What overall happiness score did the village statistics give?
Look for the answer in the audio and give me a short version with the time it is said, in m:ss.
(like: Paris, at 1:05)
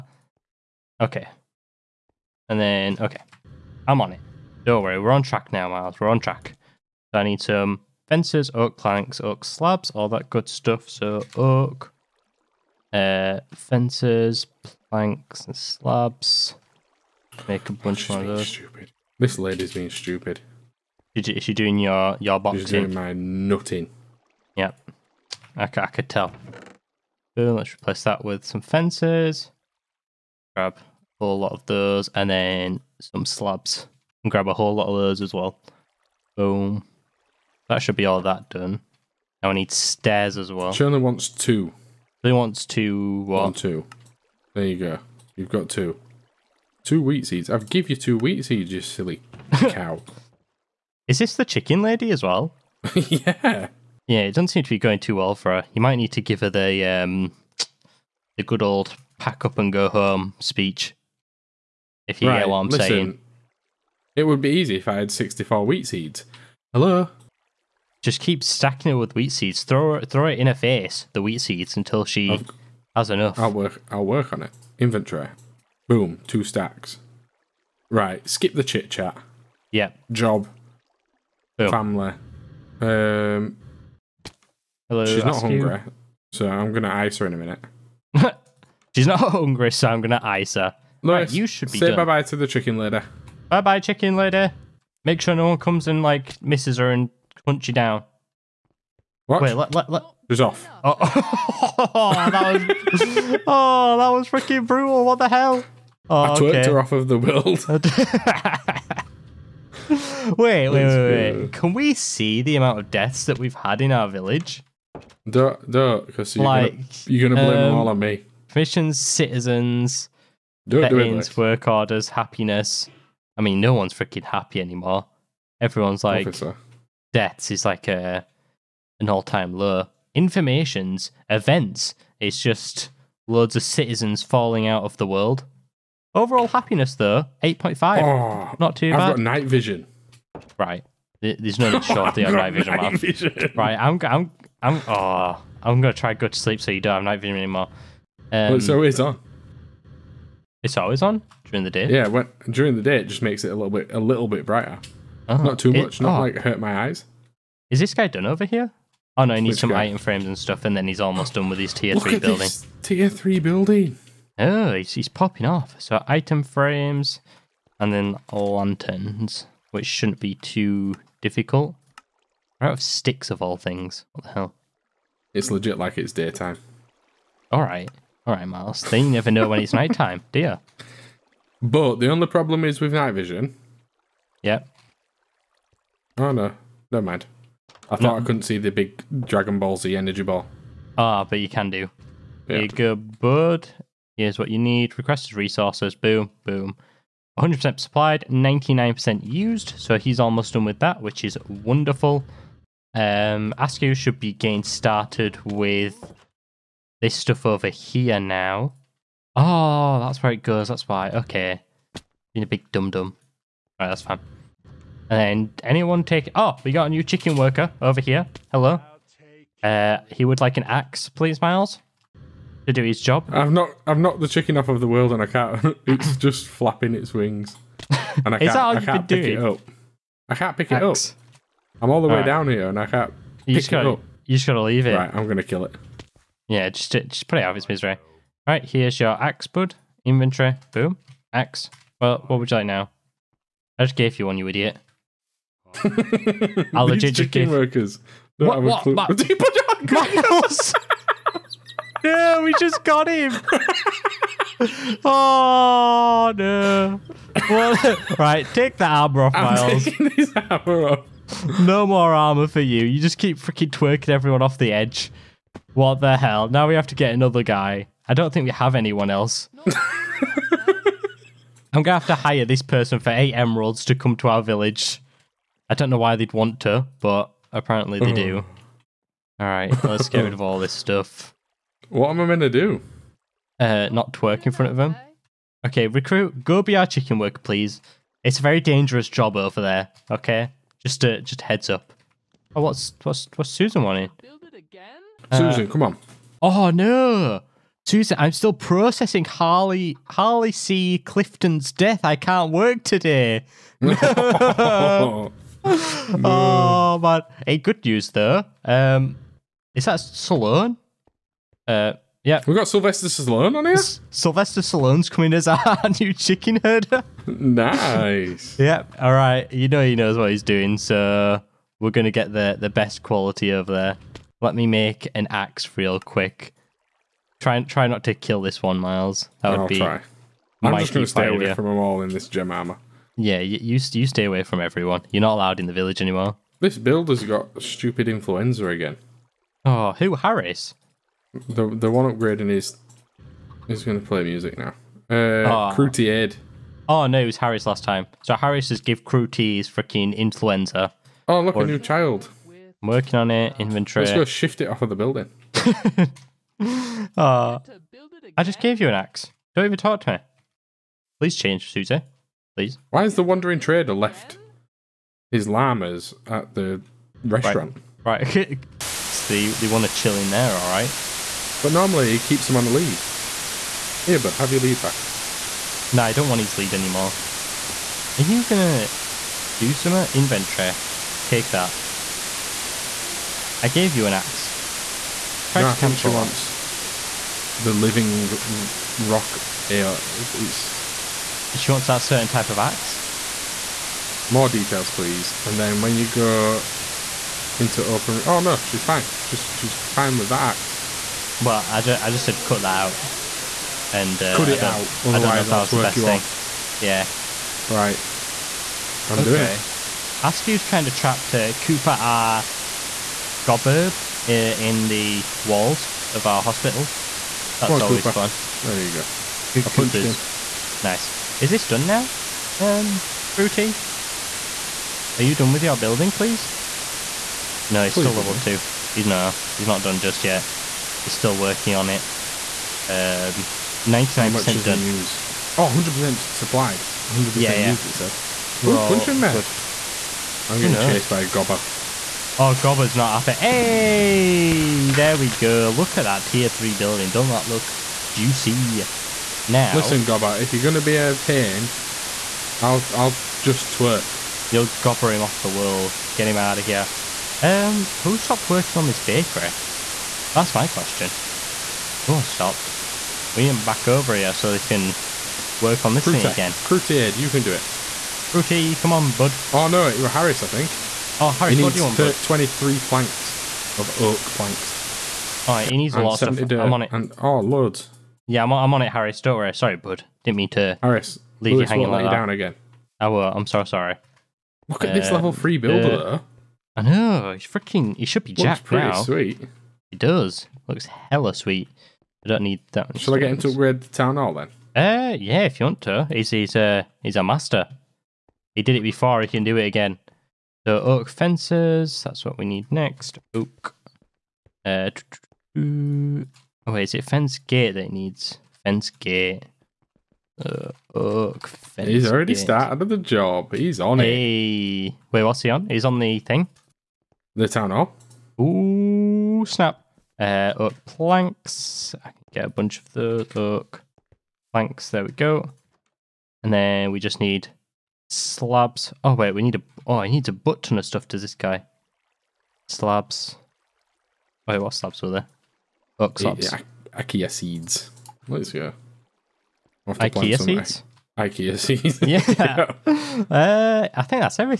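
8.5, at 2:17.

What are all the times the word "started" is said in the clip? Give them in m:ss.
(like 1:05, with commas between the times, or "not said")
3:24, 8:32.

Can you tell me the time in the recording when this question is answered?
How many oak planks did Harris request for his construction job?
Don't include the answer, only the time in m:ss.
7:52.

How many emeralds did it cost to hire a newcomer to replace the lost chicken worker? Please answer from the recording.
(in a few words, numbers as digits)
8.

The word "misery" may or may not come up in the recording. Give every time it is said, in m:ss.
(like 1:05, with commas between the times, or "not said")
3:57.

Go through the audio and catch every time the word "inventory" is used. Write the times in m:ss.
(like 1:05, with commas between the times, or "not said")
1:14, 4:00, 5:53, 6:20.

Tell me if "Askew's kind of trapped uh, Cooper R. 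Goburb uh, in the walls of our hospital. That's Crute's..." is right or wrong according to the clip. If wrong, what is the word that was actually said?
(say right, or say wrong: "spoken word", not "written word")
wrong: "Where", not "Crute".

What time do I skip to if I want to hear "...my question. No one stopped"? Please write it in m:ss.
7:40.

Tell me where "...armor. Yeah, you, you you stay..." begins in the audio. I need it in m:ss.
5:32.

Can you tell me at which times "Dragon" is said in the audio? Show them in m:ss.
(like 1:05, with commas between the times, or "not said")
3:09.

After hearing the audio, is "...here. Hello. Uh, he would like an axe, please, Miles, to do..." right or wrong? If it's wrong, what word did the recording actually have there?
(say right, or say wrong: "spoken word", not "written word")
right.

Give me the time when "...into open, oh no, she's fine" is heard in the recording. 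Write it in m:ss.
6:37.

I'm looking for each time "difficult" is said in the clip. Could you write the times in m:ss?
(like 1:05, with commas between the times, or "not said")
2:51.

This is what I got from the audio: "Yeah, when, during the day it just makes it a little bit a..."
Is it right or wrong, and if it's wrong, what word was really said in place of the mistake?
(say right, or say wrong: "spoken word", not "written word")
right.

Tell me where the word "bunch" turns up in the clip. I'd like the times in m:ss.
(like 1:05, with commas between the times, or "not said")
0:17, 8:42.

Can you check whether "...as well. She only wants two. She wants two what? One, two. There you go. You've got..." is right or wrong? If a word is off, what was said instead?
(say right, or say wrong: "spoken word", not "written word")
right.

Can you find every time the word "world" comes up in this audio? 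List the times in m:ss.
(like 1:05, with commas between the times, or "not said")
1:47, 2:15, 3:44, 7:35.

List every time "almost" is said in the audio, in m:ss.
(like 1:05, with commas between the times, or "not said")
2:41, 3:20.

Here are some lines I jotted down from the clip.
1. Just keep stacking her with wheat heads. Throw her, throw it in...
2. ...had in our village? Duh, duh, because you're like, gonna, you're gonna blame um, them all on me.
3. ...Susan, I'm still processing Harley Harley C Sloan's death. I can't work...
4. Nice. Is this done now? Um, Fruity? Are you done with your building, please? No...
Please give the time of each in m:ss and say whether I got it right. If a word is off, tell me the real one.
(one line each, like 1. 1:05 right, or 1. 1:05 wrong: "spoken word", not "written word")
1. 1:08 wrong: "seeds", not "heads"
2. 1:53 right
3. 4:57 wrong: "Clifton", not "Sloan"
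4. 7:00 right.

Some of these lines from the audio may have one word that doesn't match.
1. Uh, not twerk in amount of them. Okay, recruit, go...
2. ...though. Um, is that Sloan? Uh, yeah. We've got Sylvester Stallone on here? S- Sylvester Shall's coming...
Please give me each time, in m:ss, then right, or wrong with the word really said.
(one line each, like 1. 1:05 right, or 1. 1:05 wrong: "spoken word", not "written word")
1. 4:43 wrong: "front", not "amount"
2. 5:08 wrong: "Stallone", not "Shall".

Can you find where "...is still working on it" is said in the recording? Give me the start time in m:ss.
7:11.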